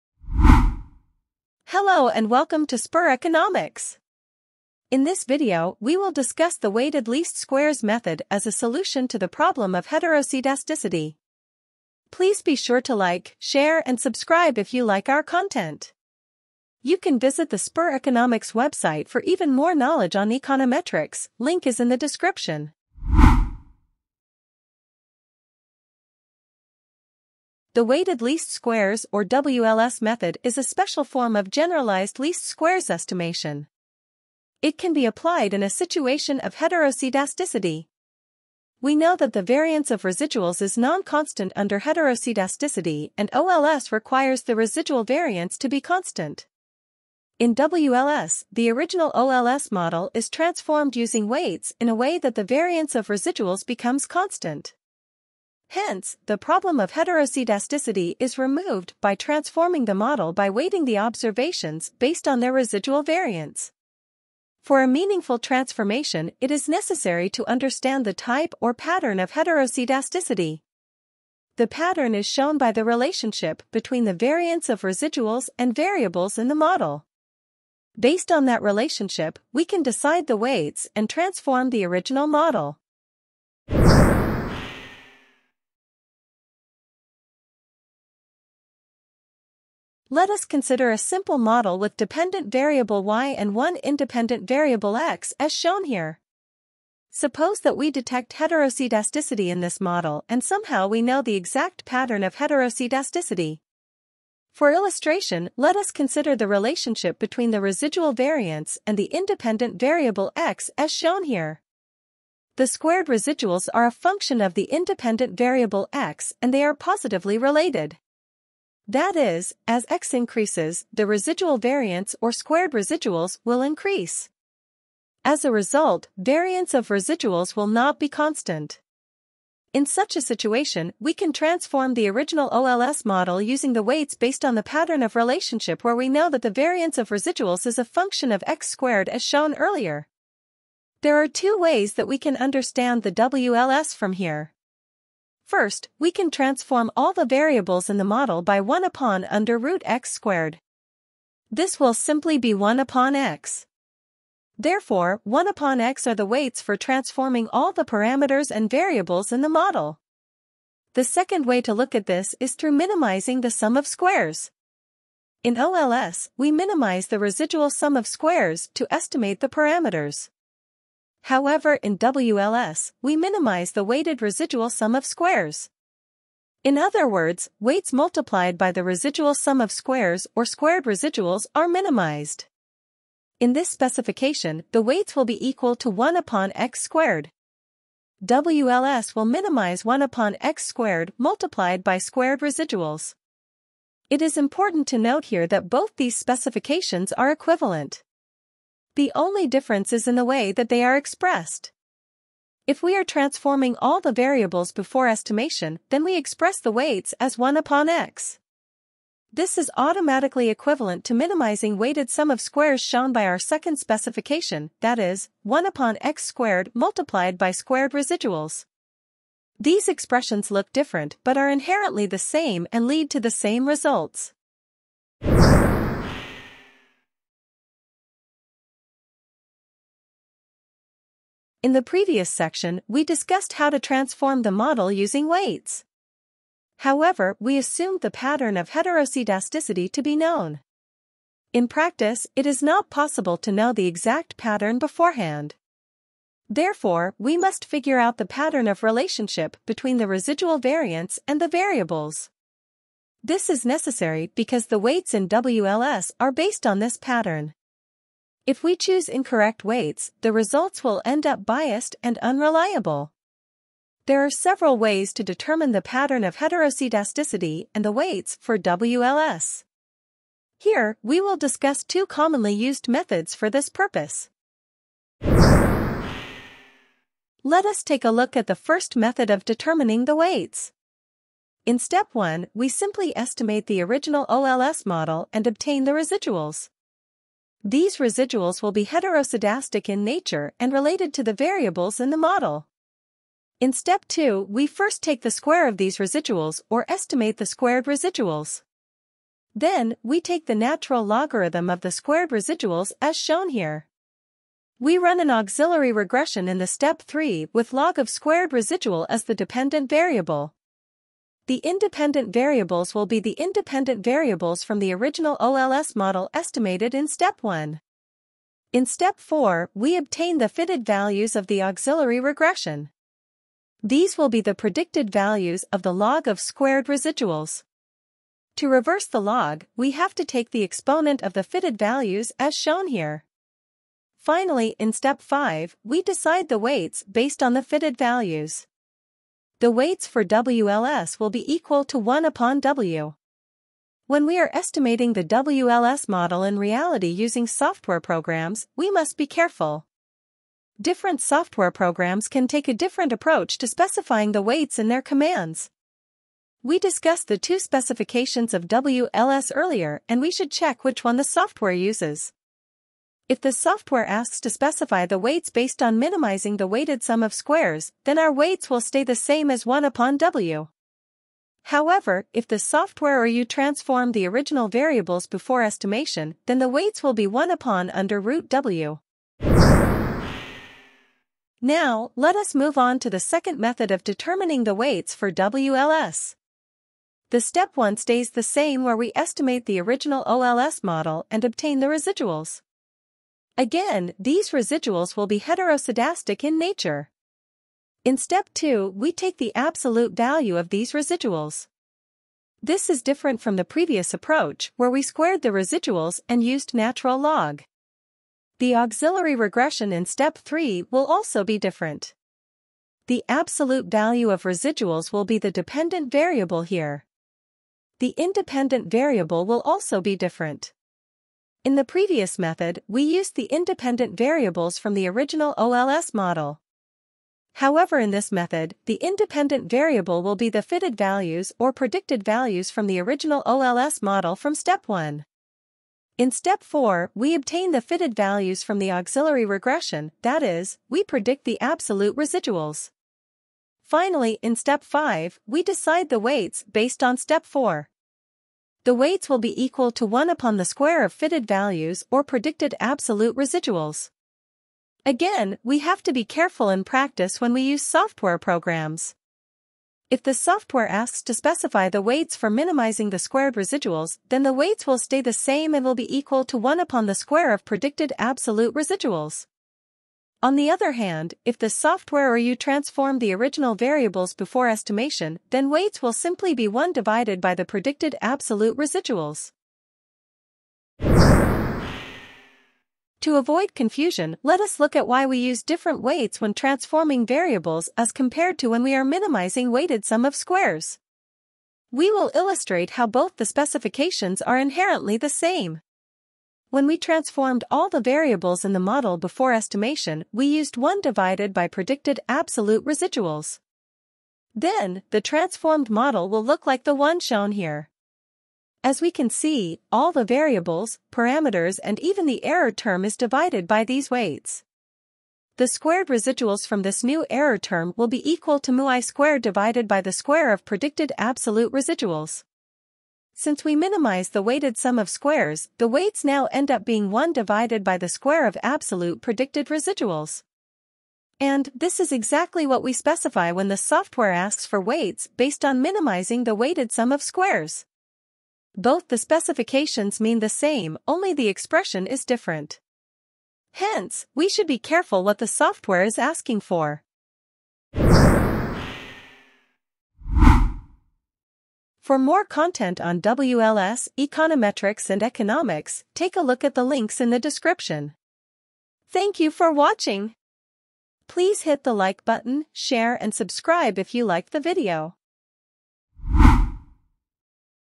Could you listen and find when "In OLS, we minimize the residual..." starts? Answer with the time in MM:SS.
02:45.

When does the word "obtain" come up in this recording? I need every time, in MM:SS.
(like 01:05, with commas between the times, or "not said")
04:45, 05:19, 06:31, 07:17.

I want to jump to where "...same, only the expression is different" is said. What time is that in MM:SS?
09:00.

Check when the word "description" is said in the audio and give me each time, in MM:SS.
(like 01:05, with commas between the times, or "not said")
00:21, 09:17.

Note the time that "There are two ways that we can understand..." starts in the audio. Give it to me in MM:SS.
02:21.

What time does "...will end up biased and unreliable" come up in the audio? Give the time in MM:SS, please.
04:20.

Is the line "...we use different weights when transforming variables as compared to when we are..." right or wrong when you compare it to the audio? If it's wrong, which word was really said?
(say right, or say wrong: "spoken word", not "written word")
right.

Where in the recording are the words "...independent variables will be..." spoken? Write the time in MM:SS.
05:11.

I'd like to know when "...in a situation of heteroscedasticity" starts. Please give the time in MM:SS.
00:35.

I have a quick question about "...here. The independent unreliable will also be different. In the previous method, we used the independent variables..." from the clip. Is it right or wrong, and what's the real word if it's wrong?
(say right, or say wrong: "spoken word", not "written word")
wrong: "variable", not "unreliable".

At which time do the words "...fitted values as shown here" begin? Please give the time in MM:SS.
05:31.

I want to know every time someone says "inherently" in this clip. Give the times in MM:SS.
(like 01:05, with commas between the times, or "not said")
03:41, 08:14.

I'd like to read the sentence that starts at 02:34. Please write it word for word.
Therefore, 1 upon x are the weights for transforming all the parameters and variables in the model.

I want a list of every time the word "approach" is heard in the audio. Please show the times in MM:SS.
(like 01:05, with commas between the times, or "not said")
05:53, 06:44.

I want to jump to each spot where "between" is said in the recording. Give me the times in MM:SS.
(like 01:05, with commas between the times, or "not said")
01:13, 01:47, 04:09.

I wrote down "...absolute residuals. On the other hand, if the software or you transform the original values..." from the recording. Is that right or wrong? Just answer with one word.
wrong.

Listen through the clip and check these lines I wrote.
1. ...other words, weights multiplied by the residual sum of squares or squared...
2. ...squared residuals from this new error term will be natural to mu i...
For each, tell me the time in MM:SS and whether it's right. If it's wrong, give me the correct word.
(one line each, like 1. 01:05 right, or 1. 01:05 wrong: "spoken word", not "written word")
1. 02:56 right
2. 08:35 wrong: "equal", not "natural".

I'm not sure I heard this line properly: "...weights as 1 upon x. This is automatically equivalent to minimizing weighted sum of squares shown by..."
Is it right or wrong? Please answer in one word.
right.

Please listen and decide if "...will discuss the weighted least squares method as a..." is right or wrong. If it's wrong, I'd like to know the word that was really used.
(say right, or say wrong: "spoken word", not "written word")
right.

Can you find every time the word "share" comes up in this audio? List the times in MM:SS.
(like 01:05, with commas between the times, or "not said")
00:13, 09:22.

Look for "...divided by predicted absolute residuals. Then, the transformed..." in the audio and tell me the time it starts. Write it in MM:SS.
08:21.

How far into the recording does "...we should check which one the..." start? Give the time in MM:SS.
06:00.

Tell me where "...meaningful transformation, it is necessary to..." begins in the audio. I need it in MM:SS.
01:04.